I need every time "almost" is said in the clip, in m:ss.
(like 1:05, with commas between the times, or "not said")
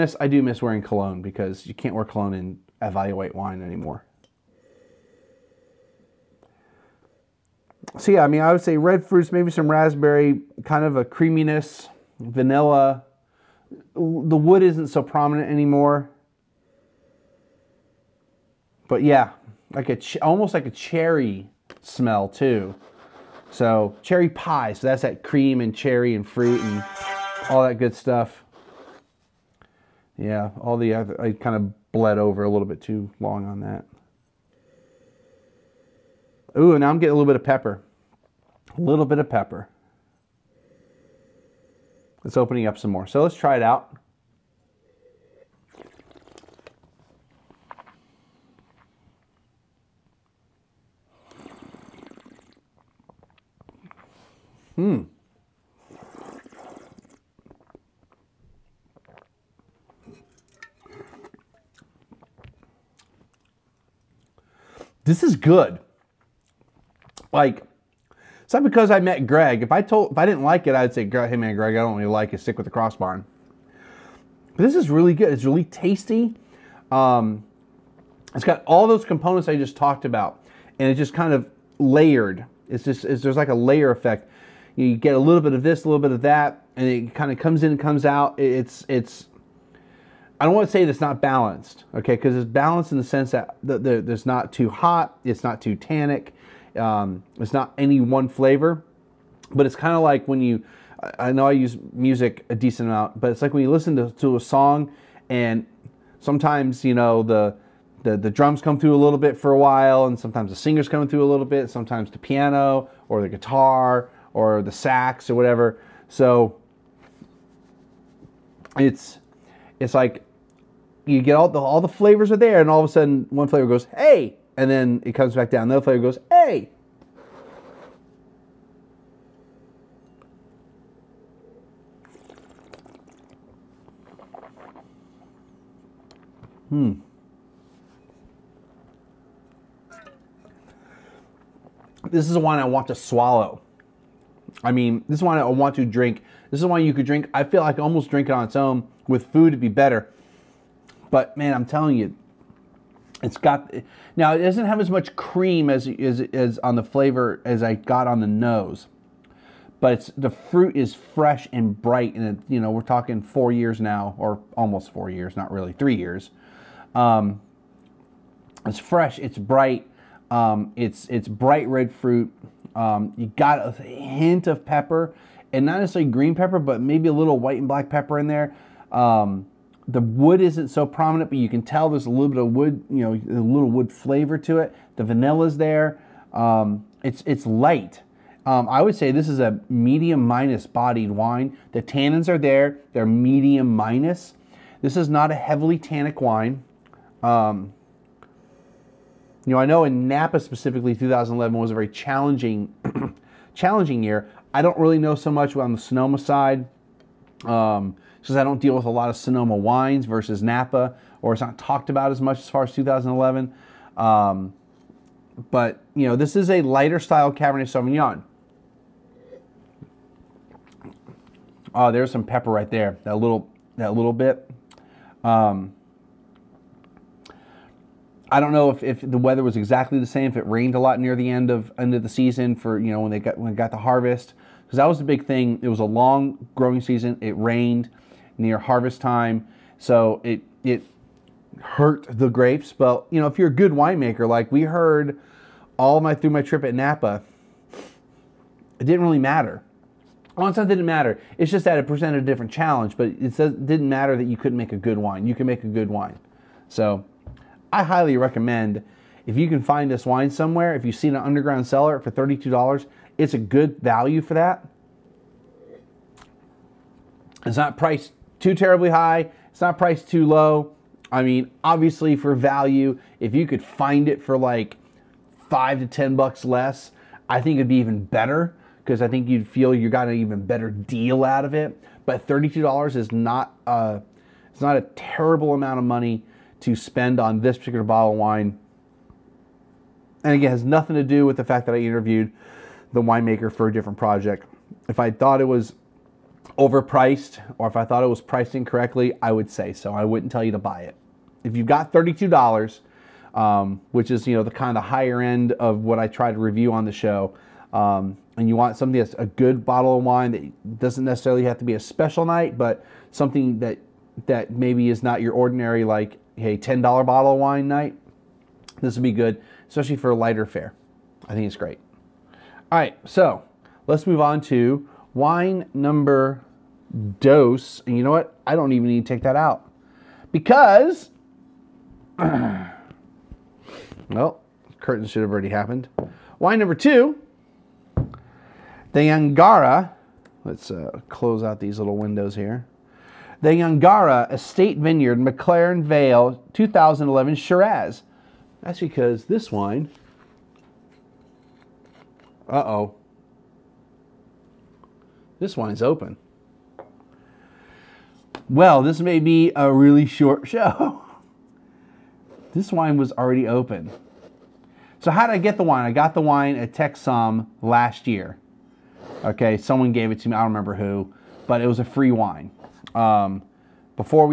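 0:20, 2:27, 2:44.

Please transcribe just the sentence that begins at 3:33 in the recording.
Um, but you know, this is a lighter style Cabernet Sauvignon.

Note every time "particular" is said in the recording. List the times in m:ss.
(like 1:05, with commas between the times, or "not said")
4:47.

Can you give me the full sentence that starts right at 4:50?
And again, has nothing to do with the fact that I interviewed the winemaker for a different project.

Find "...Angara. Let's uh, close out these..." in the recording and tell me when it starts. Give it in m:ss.
5:39.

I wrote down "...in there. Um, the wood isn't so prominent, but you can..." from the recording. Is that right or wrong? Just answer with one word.
right.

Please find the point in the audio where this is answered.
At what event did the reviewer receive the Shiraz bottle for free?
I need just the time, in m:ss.
6:06.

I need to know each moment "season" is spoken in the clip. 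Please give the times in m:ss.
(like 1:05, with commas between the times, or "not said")
3:52, 3:56.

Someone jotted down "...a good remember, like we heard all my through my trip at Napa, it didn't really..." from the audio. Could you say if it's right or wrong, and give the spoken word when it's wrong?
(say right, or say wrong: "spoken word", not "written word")
wrong: "winemaker", not "remember".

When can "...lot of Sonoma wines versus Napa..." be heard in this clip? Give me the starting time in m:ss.
3:28.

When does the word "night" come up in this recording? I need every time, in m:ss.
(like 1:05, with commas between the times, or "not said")
5:12, 5:17.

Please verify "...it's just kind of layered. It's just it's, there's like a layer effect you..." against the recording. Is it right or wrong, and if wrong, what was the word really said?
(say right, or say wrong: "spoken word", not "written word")
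right.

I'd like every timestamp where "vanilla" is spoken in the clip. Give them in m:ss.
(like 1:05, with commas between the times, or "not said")
0:12, 3:05.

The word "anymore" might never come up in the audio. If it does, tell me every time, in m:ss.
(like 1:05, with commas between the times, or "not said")
0:03, 0:15.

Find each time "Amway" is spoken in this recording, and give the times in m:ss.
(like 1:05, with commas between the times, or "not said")
not said.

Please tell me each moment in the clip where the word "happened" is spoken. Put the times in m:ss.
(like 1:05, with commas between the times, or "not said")
5:35.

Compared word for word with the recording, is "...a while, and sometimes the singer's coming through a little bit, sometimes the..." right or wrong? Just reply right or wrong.
right.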